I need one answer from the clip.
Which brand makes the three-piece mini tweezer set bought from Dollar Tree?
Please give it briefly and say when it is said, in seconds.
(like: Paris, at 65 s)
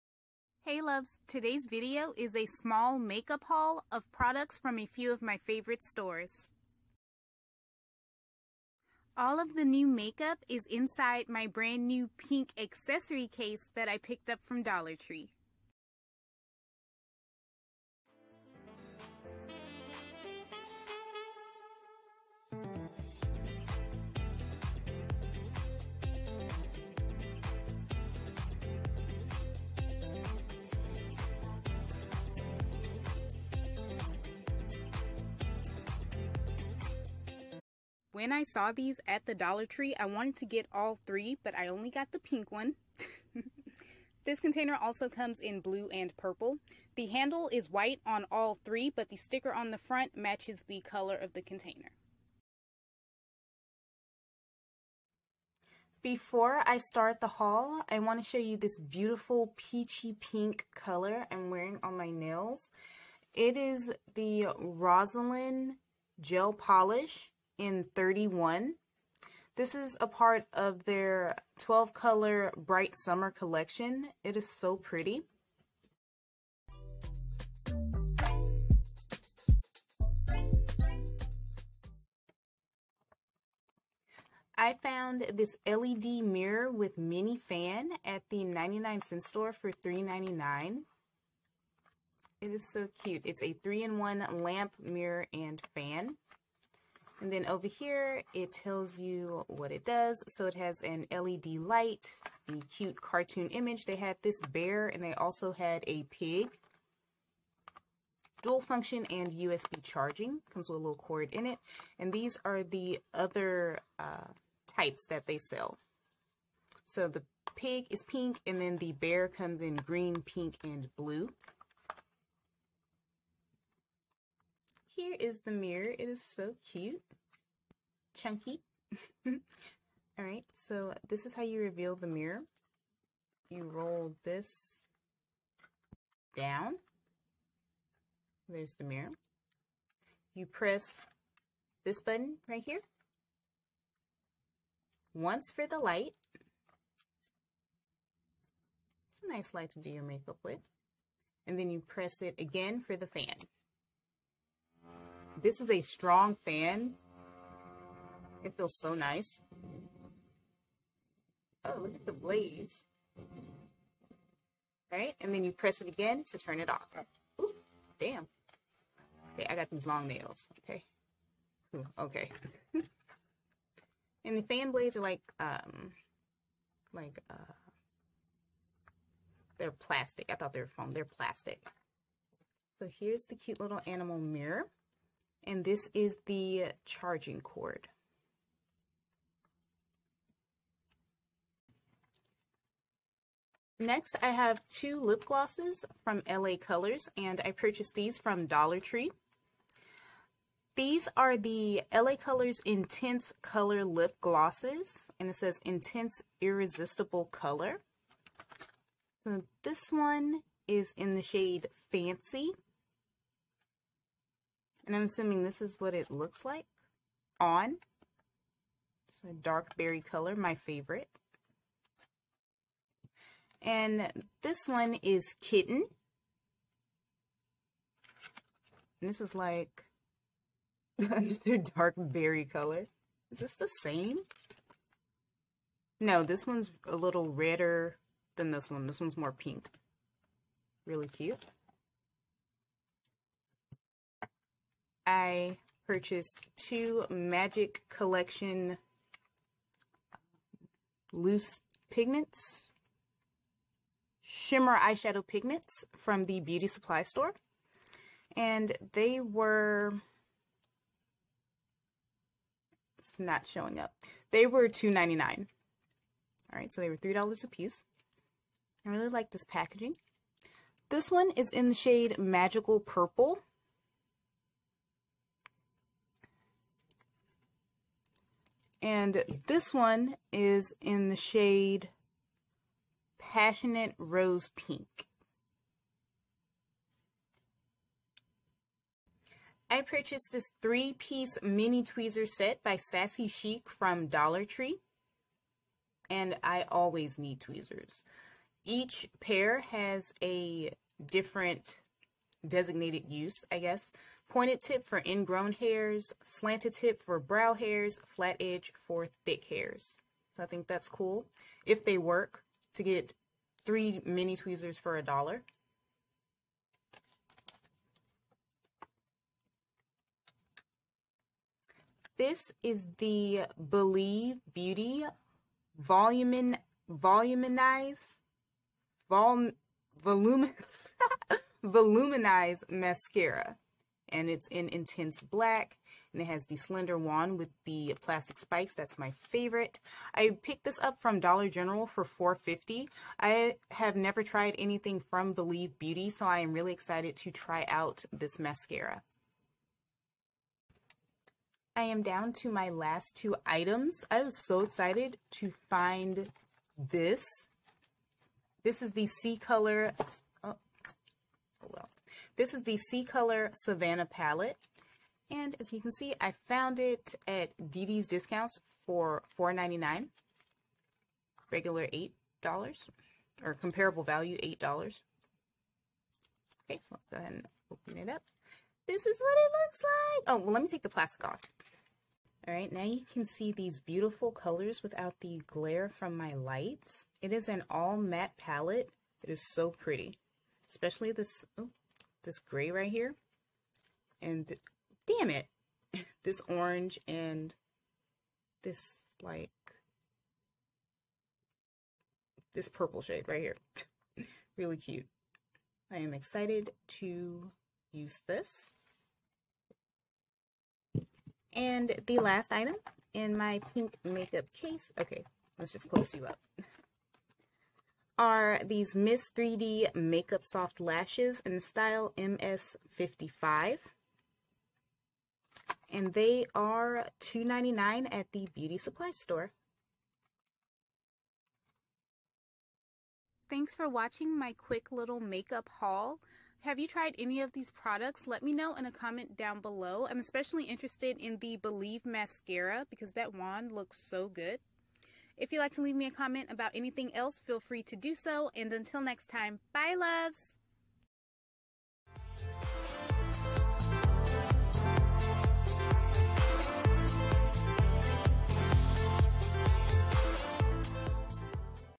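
Sassy Chic, at 292 s.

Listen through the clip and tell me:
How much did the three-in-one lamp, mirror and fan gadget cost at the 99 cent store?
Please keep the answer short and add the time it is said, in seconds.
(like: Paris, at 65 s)
$3.99, at 89 s.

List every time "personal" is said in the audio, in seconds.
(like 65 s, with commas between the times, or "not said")
not said.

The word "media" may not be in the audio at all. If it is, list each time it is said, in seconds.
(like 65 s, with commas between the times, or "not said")
not said.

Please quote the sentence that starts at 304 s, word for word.
Pointed tip for ingrown hairs, slanted tip for brow hairs, flat edge for thick hairs.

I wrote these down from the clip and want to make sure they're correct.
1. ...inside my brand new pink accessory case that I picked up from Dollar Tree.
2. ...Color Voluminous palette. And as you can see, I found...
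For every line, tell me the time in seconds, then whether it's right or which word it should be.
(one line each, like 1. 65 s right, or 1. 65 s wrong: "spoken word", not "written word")
1. 10 s right
2. 363 s wrong: "Savannah", not "Voluminous".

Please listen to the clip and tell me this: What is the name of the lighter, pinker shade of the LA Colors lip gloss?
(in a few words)
Kitten.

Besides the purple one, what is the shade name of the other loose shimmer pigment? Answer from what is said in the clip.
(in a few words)
Passionate Rose Pink.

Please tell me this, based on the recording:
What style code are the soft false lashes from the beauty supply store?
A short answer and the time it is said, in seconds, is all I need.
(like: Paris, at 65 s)
MS55, at 422 s.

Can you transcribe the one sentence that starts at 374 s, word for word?
Okay, so let's go ahead and open it up.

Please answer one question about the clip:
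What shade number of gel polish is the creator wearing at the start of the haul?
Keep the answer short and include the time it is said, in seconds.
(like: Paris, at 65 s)
31, at 67 s.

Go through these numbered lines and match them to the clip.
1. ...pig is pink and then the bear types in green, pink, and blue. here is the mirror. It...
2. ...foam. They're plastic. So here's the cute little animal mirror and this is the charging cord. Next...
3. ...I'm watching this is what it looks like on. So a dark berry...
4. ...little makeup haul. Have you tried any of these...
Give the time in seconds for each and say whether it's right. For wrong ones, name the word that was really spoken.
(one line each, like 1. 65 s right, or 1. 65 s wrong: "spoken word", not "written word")
1. 117 s wrong: "comes", not "types"
2. 180 s right
3. 214 s wrong: "assuming", not "watching"
4. 434 s right.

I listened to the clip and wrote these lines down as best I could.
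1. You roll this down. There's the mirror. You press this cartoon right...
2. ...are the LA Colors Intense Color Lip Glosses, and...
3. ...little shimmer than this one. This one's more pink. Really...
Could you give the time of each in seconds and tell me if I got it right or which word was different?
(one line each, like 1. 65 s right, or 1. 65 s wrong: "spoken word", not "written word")
1. 133 s wrong: "button", not "cartoon"
2. 201 s right
3. 236 s wrong: "redder", not "shimmer".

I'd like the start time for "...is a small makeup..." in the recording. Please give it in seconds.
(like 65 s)
2 s.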